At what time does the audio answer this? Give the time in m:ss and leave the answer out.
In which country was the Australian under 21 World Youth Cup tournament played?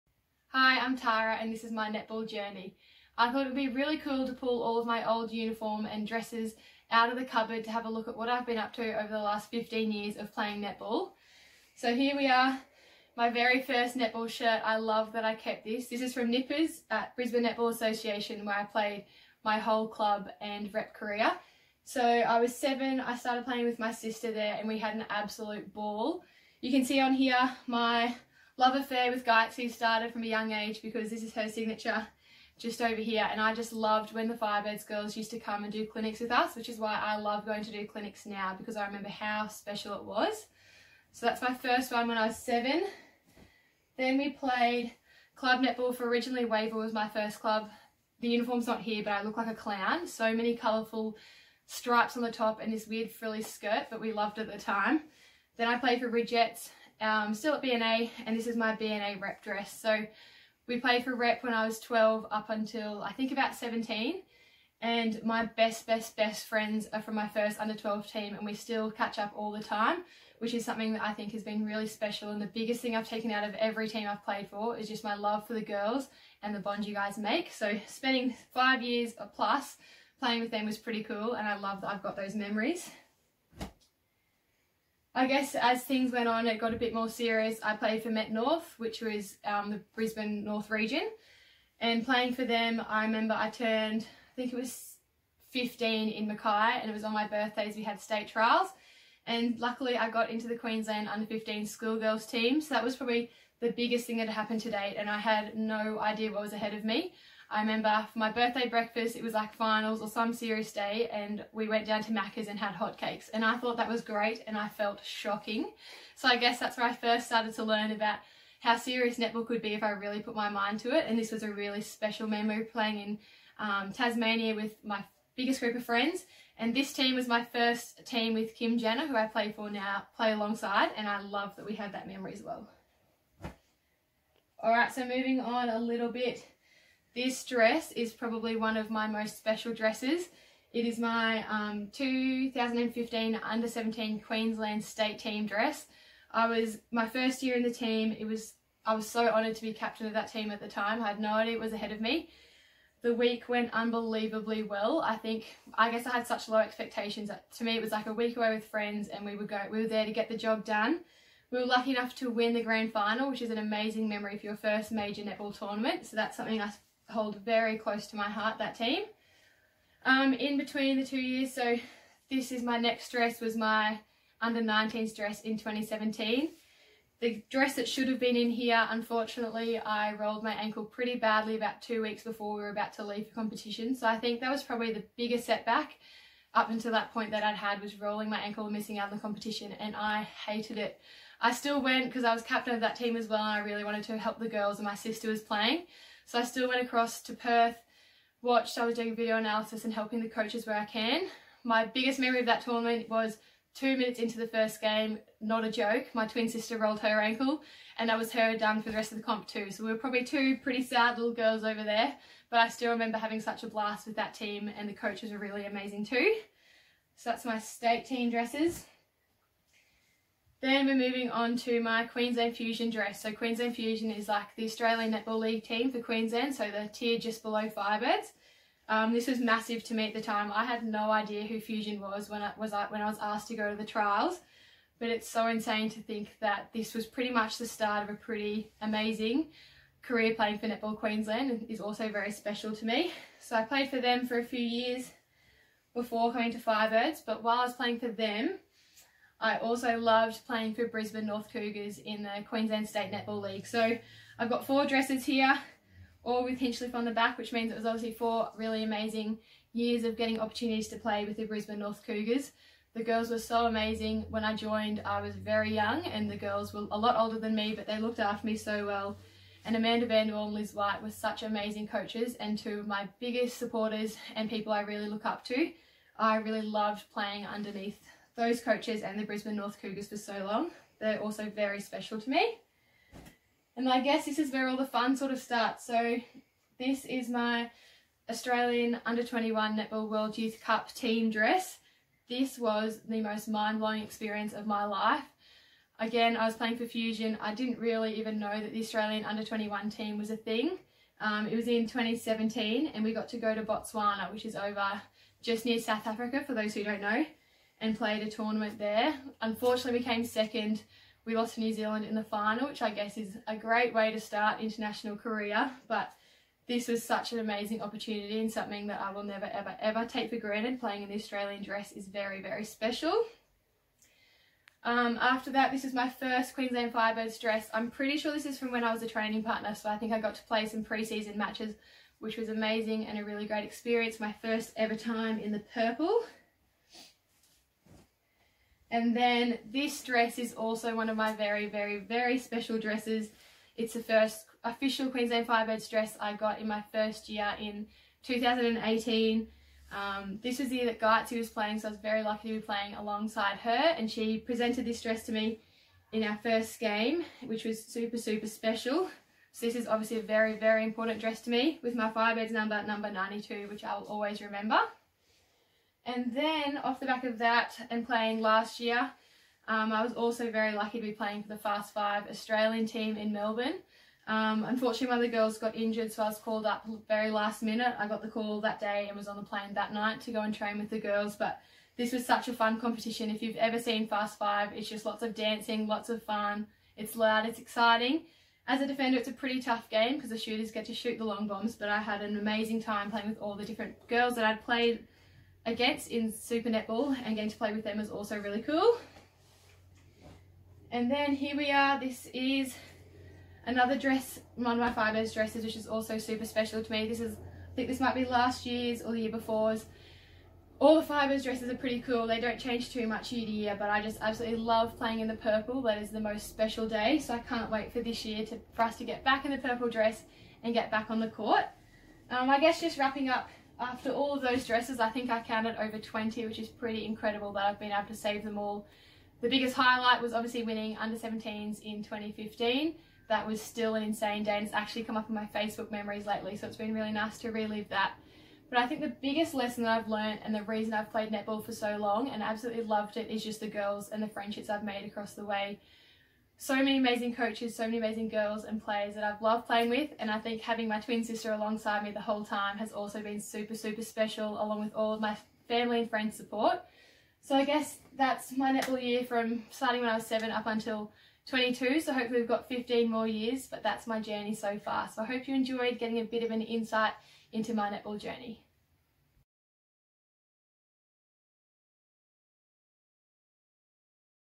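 5:03.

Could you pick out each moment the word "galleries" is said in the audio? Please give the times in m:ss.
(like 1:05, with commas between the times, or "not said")
not said.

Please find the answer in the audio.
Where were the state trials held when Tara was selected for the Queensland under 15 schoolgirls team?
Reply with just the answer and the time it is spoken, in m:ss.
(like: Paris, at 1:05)
Mackay, at 1:36.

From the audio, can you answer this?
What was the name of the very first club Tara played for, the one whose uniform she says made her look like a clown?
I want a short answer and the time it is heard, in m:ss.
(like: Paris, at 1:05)
Waver, at 0:46.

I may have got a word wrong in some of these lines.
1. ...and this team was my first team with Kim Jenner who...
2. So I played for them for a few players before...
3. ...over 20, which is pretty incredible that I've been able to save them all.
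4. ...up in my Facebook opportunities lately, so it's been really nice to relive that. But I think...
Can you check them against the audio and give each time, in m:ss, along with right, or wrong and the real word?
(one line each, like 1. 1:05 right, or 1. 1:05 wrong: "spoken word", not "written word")
1. 2:06 right
2. 4:03 wrong: "years", not "players"
3. 7:05 right
4. 7:15 wrong: "memories", not "opportunities".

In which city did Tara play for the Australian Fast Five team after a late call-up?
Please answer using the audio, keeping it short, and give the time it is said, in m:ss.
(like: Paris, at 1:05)
Melbourne, at 6:13.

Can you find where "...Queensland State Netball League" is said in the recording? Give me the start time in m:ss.
4:12.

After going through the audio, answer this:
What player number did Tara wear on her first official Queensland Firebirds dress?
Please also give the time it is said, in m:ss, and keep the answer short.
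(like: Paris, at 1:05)
92, at 6:03.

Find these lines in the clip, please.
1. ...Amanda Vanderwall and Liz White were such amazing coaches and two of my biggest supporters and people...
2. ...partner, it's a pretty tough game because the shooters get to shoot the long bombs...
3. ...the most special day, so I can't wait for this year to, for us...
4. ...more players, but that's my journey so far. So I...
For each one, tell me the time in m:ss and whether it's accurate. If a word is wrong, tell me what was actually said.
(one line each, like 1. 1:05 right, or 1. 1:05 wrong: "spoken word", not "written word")
1. 4:29 right
2. 6:28 wrong: "defender", not "partner"
3. 6:56 right
4. 7:43 wrong: "years", not "players".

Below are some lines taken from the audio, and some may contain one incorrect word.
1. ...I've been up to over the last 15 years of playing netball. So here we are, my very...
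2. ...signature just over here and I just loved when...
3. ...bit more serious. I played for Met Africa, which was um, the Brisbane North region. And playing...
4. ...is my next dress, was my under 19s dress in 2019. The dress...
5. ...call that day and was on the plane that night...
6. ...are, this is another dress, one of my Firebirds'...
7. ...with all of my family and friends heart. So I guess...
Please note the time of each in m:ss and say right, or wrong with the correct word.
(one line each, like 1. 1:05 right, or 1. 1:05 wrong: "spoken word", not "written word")
1. 0:08 right
2. 0:31 right
3. 1:26 wrong: "North", not "Africa"
4. 2:52 wrong: "2017", not "2019"
5. 6:18 right
6. 6:41 right
7. 7:34 wrong: "support", not "heart".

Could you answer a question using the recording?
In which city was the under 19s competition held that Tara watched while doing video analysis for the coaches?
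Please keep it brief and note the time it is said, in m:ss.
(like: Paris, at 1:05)
Perth, at 3:17.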